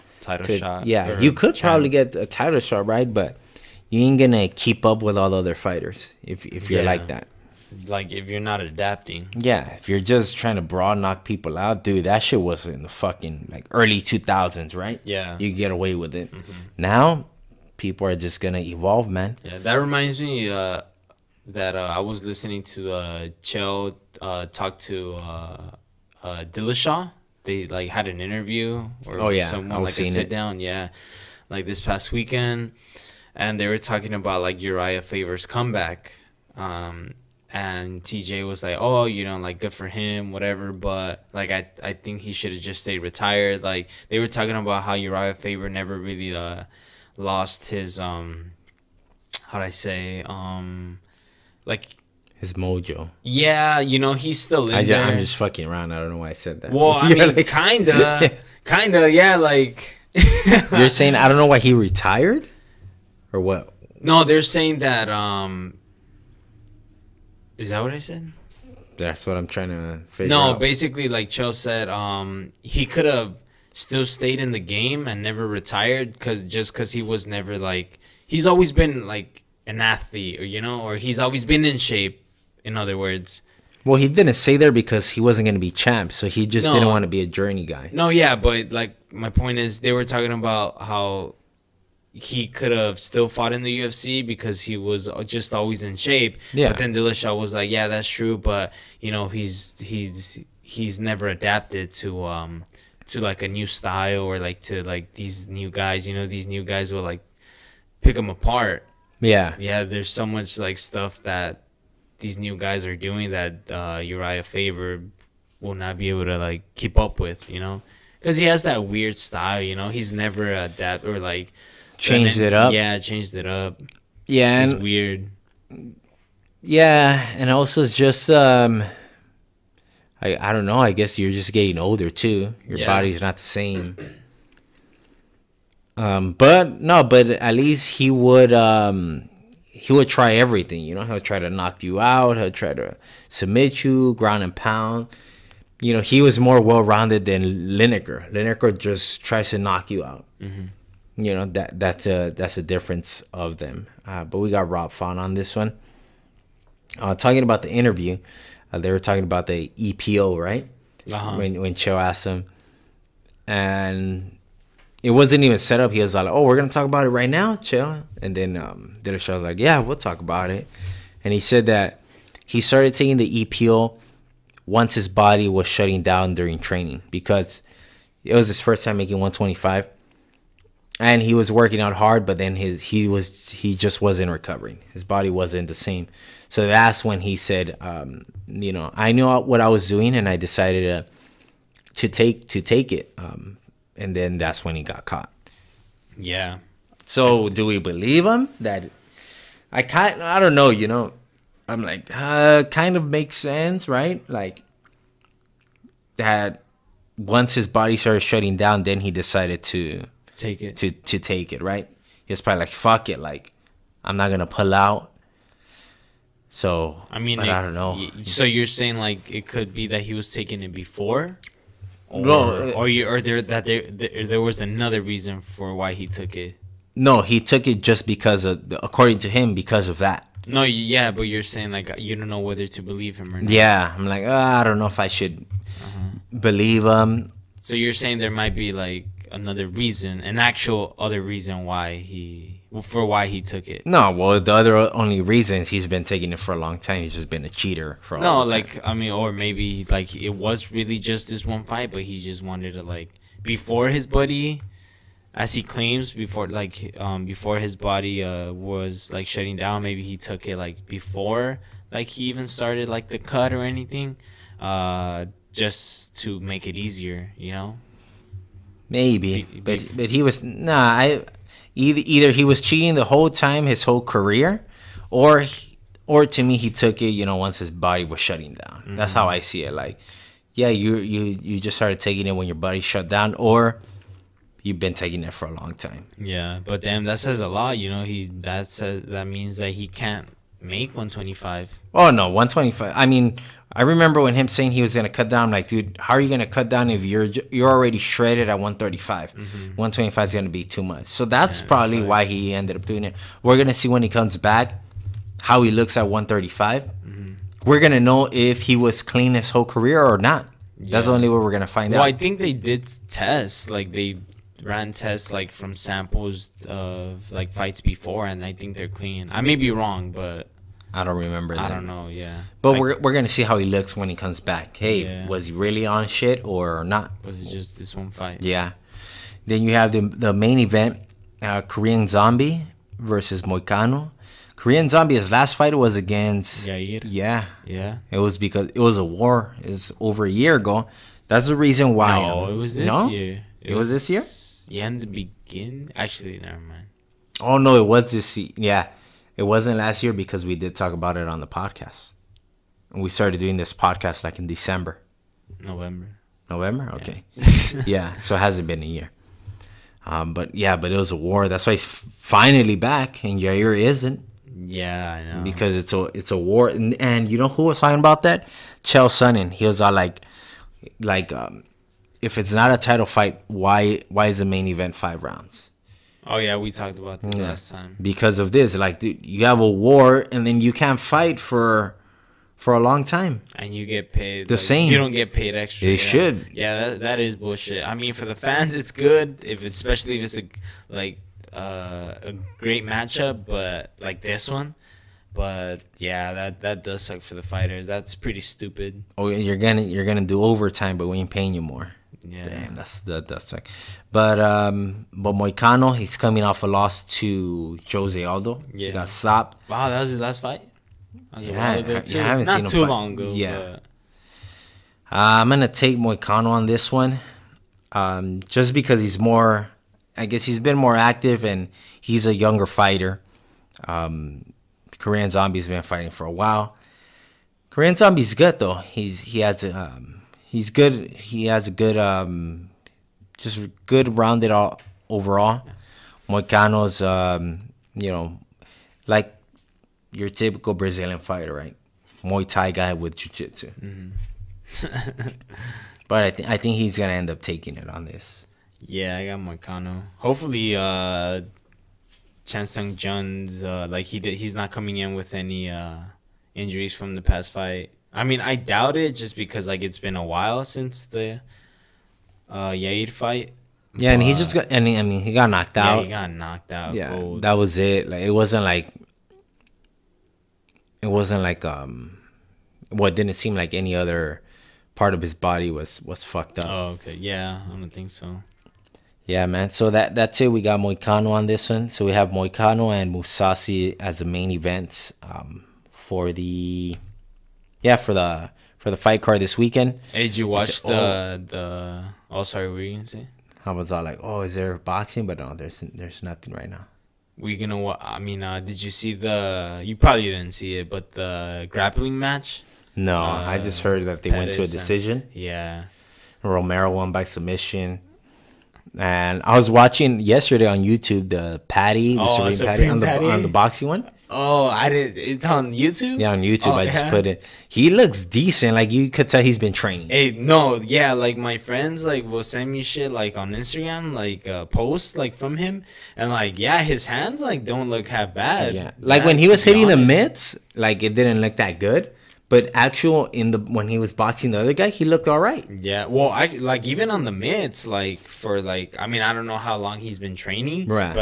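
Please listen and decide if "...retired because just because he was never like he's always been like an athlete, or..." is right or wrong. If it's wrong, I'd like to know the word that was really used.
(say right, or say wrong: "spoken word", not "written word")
right.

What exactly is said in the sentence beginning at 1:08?
That's what I'm trying to figure no, out.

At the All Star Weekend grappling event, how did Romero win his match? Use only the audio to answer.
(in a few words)
By submission.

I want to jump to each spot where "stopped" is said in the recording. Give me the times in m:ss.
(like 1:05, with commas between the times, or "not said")
6:49.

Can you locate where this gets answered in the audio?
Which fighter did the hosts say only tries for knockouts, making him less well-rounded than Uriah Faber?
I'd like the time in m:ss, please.
2:28.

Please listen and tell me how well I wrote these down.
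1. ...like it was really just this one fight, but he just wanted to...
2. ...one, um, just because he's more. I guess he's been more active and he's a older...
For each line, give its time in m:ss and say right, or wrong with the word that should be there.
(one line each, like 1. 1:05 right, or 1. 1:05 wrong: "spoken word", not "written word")
1. 4:09 right
2. 6:56 wrong: "younger", not "older".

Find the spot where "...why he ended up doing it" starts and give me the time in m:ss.
5:02.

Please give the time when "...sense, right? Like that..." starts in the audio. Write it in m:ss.
3:23.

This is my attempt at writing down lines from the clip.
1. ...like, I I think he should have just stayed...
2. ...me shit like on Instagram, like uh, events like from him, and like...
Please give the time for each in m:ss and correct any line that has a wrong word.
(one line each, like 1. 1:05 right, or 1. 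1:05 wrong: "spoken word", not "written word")
1. 0:41 right
2. 8:42 wrong: "posts", not "events".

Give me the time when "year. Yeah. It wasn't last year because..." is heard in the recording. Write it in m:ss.
5:48.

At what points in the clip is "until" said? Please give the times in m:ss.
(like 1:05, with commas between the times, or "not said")
not said.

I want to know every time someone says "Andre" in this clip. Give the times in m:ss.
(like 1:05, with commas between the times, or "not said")
not said.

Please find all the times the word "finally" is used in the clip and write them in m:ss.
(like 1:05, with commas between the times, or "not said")
6:01.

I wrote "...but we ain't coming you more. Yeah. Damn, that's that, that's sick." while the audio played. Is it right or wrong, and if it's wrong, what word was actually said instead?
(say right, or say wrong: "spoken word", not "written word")
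wrong: "paying", not "coming".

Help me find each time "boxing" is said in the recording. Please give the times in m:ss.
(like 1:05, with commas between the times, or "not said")
8:14, 8:33, 8:54.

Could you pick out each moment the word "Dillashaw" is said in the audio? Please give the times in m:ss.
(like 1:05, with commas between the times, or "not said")
0:26, 1:36.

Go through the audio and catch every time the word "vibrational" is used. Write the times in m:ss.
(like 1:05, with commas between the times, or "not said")
not said.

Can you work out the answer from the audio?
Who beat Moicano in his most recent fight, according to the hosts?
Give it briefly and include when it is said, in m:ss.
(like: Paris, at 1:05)
Jose Aldo, at 6:47.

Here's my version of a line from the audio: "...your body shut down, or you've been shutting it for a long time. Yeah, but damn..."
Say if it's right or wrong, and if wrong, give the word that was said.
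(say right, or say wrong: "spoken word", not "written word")
wrong: "taking", not "shutting".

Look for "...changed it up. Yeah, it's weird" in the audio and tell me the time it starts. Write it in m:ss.
2:02.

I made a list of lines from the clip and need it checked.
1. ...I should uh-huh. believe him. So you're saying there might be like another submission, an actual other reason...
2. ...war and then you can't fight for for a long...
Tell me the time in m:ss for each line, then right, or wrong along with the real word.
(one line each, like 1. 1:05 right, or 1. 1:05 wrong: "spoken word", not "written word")
1. 3:54 wrong: "reason", not "submission"
2. 6:19 right.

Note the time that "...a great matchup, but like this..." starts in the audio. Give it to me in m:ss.
6:32.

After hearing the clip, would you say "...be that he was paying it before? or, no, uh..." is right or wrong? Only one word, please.
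wrong.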